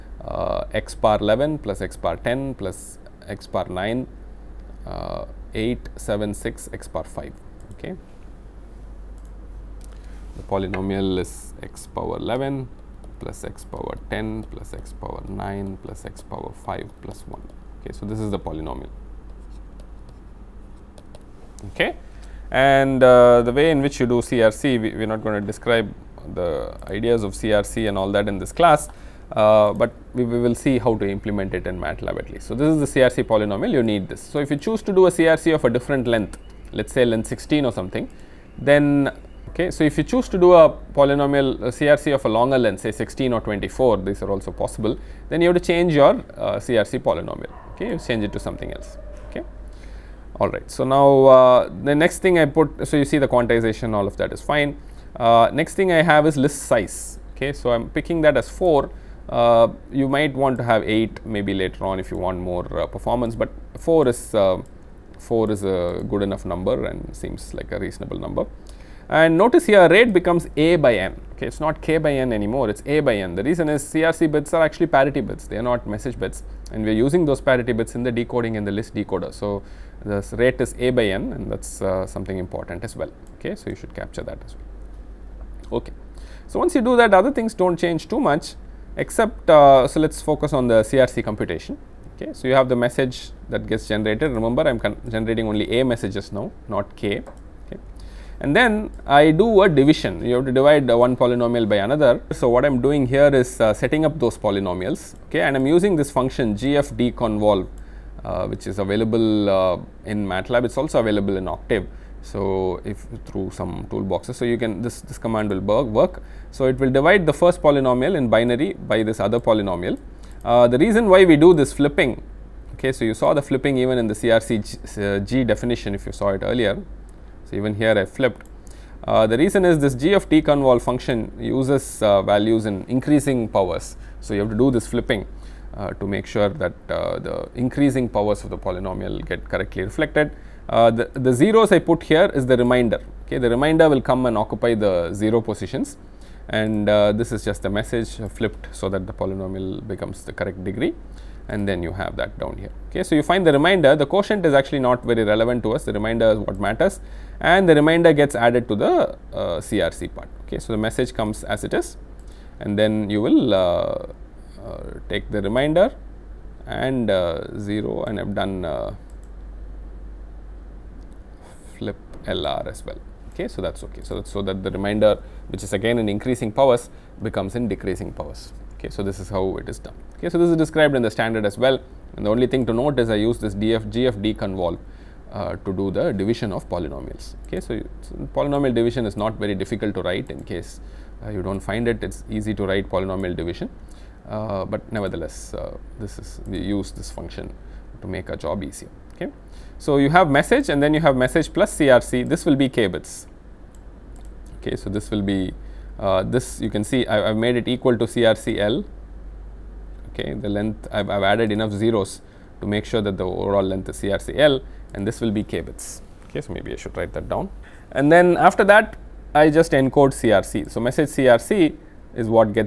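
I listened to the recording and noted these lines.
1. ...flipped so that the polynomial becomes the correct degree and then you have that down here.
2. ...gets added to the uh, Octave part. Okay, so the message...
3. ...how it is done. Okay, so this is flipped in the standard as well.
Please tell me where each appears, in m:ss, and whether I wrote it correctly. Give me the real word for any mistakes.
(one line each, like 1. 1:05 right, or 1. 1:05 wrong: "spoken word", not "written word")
1. 2:28 right
2. 2:38 wrong: "CRC", not "Octave"
3. 2:59 wrong: "described", not "flipped".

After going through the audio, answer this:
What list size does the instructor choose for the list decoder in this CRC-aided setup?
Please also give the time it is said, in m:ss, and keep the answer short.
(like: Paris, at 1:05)
4, at 0:57.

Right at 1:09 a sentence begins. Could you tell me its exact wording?
And notice here rate becomes A by N.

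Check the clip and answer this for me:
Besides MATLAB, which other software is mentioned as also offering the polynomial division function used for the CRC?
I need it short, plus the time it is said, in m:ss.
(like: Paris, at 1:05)
Octave, at 1:51.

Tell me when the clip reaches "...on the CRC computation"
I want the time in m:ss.
1:30.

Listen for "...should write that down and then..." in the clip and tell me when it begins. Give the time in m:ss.
3:36.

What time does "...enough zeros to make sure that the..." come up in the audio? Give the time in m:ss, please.
3:31.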